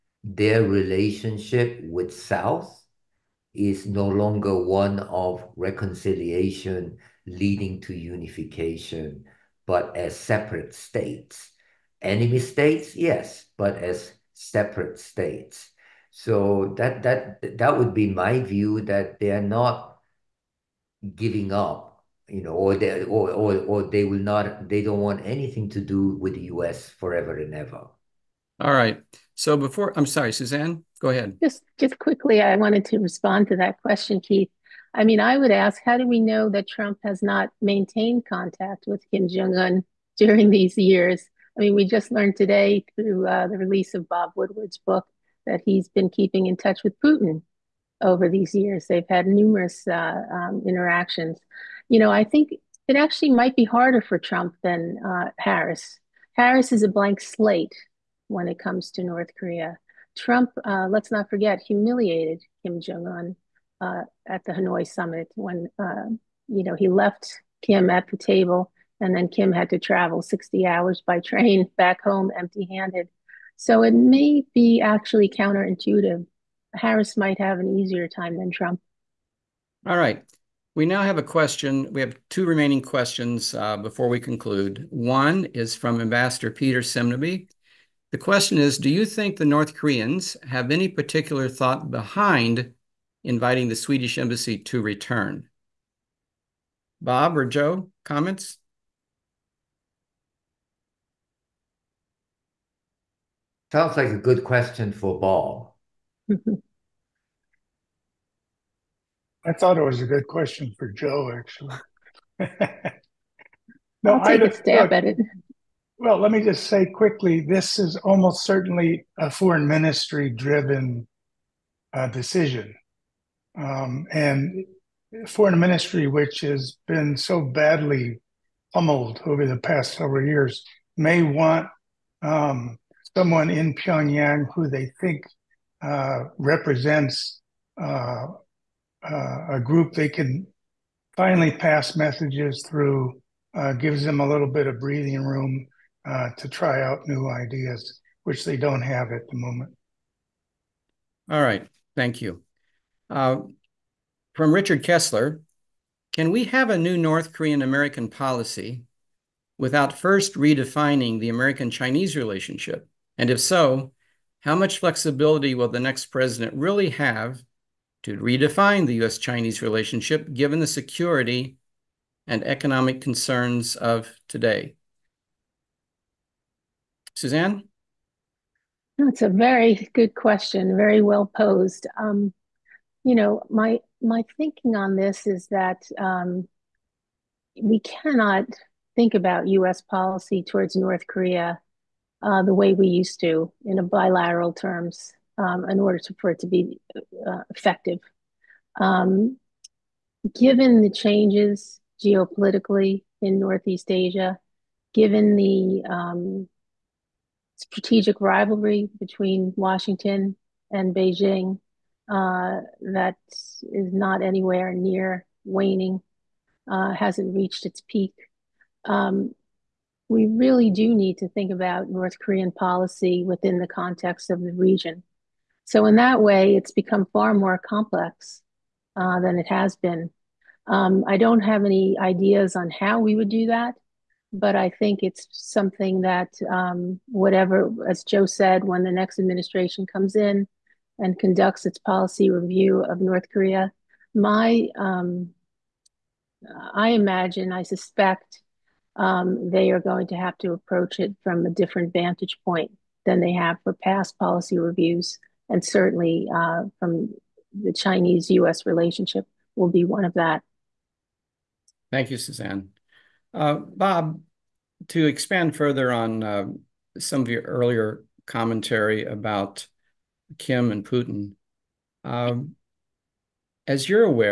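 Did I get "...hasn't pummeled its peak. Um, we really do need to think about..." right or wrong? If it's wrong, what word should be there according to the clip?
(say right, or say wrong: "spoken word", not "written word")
wrong: "reached", not "pummeled".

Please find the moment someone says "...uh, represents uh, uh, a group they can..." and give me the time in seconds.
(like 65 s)
135 s.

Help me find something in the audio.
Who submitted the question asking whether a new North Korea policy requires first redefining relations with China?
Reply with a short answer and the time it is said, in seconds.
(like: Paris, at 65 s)
Richard Kessler, at 154 s.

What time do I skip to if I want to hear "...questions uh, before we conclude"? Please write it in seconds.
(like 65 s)
82 s.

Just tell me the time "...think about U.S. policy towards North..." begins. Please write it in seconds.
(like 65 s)
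188 s.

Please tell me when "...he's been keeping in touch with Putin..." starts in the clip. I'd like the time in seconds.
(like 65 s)
45 s.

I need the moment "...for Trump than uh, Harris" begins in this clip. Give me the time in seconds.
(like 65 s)
54 s.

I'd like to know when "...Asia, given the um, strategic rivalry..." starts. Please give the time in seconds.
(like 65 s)
203 s.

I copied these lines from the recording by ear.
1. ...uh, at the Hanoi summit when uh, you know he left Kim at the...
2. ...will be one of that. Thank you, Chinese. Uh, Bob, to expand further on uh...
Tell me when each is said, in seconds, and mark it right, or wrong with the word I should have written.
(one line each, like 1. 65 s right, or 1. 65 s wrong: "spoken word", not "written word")
1. 63 s right
2. 259 s wrong: "Suzanne", not "Chinese".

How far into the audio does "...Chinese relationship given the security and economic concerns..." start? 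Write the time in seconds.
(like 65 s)
169 s.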